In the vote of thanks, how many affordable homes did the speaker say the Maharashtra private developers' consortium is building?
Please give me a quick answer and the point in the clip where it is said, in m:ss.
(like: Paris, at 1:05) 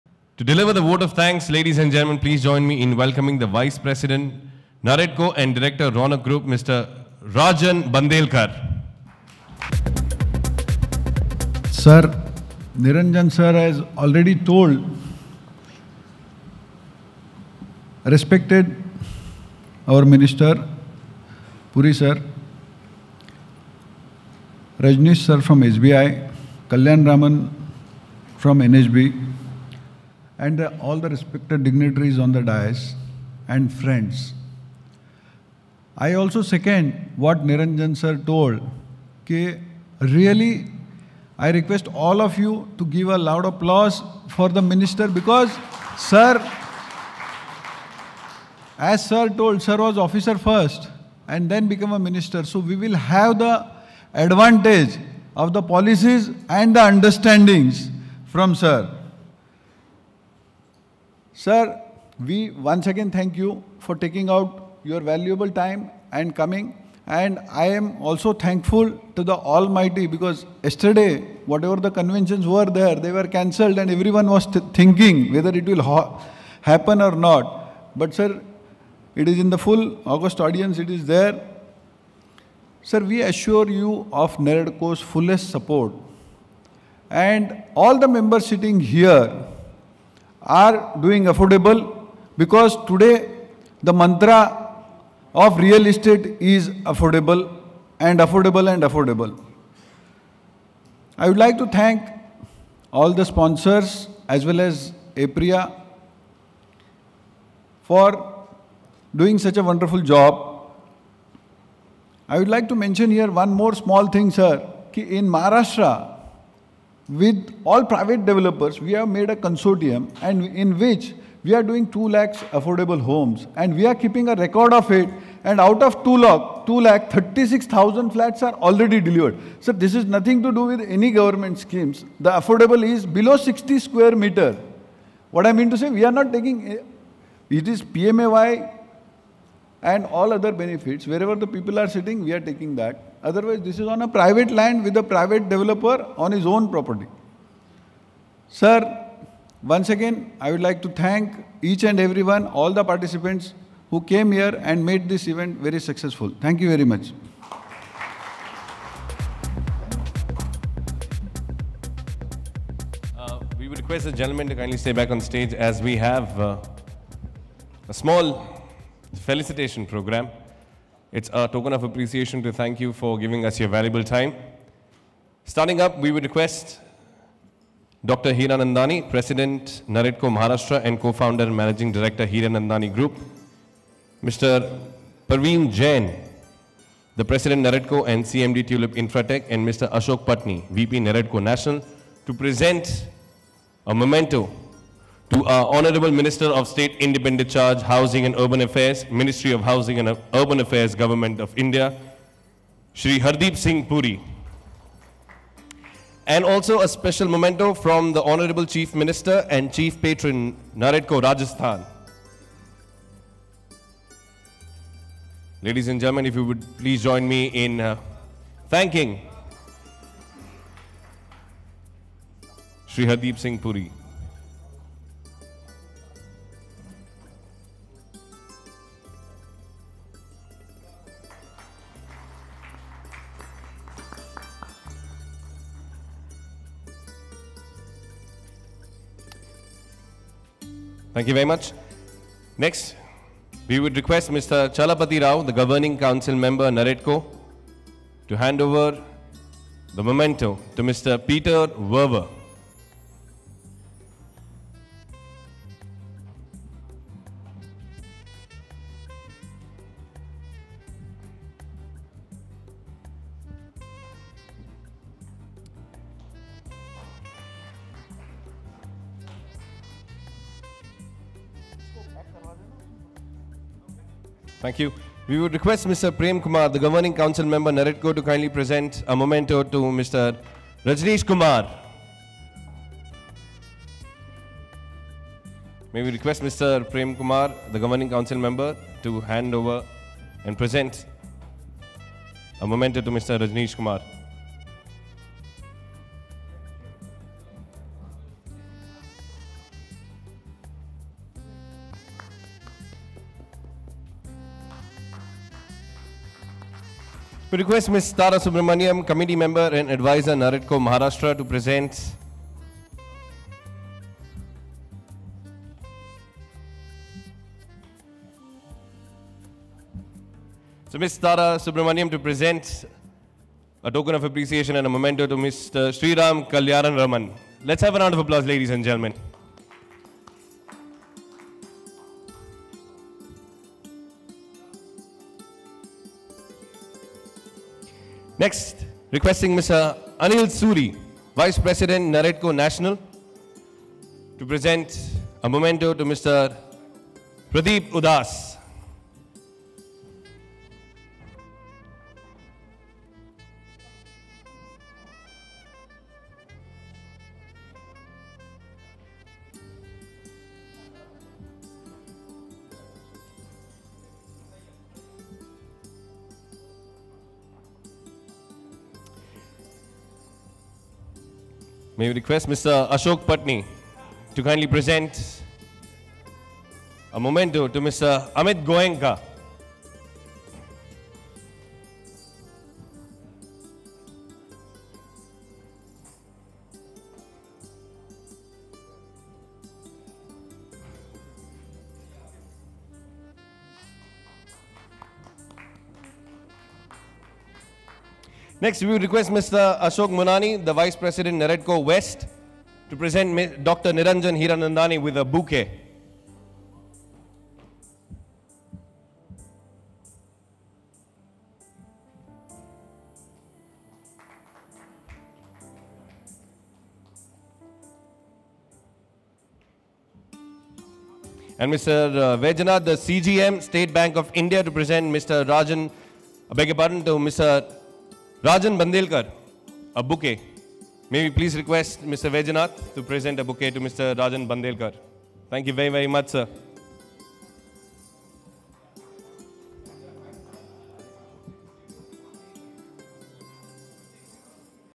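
2 lakhs, at 2:01.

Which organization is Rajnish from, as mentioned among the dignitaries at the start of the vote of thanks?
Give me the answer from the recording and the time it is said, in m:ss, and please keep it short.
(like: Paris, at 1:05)
SBI, at 0:25.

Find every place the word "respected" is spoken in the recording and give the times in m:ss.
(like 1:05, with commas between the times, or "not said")
0:18, 0:31.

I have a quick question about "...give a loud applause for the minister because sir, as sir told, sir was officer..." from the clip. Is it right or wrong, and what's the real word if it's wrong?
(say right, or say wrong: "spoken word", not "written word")
right.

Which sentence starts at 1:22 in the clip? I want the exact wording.
Sir, we assure you of Naredco's fullest support.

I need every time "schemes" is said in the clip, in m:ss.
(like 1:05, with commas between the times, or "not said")
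2:11.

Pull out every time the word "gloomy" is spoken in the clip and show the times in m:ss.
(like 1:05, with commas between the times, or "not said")
not said.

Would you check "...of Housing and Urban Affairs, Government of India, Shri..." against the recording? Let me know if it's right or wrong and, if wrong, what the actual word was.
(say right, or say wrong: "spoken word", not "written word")
right.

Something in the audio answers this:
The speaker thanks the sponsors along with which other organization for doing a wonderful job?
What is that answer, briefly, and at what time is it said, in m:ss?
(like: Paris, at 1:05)
APREA, at 1:45.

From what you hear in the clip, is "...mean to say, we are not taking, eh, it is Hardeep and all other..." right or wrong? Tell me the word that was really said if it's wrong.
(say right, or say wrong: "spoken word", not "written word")
wrong: "PMAY", not "Hardeep".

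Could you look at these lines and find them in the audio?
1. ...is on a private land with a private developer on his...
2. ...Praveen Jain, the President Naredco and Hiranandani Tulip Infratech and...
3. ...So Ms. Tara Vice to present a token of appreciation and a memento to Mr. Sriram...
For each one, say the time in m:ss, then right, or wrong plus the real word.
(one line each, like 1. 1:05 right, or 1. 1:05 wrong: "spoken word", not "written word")
1. 2:23 right
2. 3:05 wrong: "CMD", not "Hiranandani"
3. 5:20 wrong: "Subramaniam", not "Vice".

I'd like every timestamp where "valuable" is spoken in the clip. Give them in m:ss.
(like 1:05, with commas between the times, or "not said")
1:04, 2:53.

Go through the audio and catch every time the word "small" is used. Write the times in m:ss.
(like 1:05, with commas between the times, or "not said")
1:53, 2:47.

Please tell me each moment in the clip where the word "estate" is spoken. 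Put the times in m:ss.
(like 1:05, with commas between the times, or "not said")
1:35.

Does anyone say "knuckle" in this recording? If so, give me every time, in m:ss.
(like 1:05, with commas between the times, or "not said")
not said.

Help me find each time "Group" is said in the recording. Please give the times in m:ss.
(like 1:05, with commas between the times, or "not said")
0:06, 3:02.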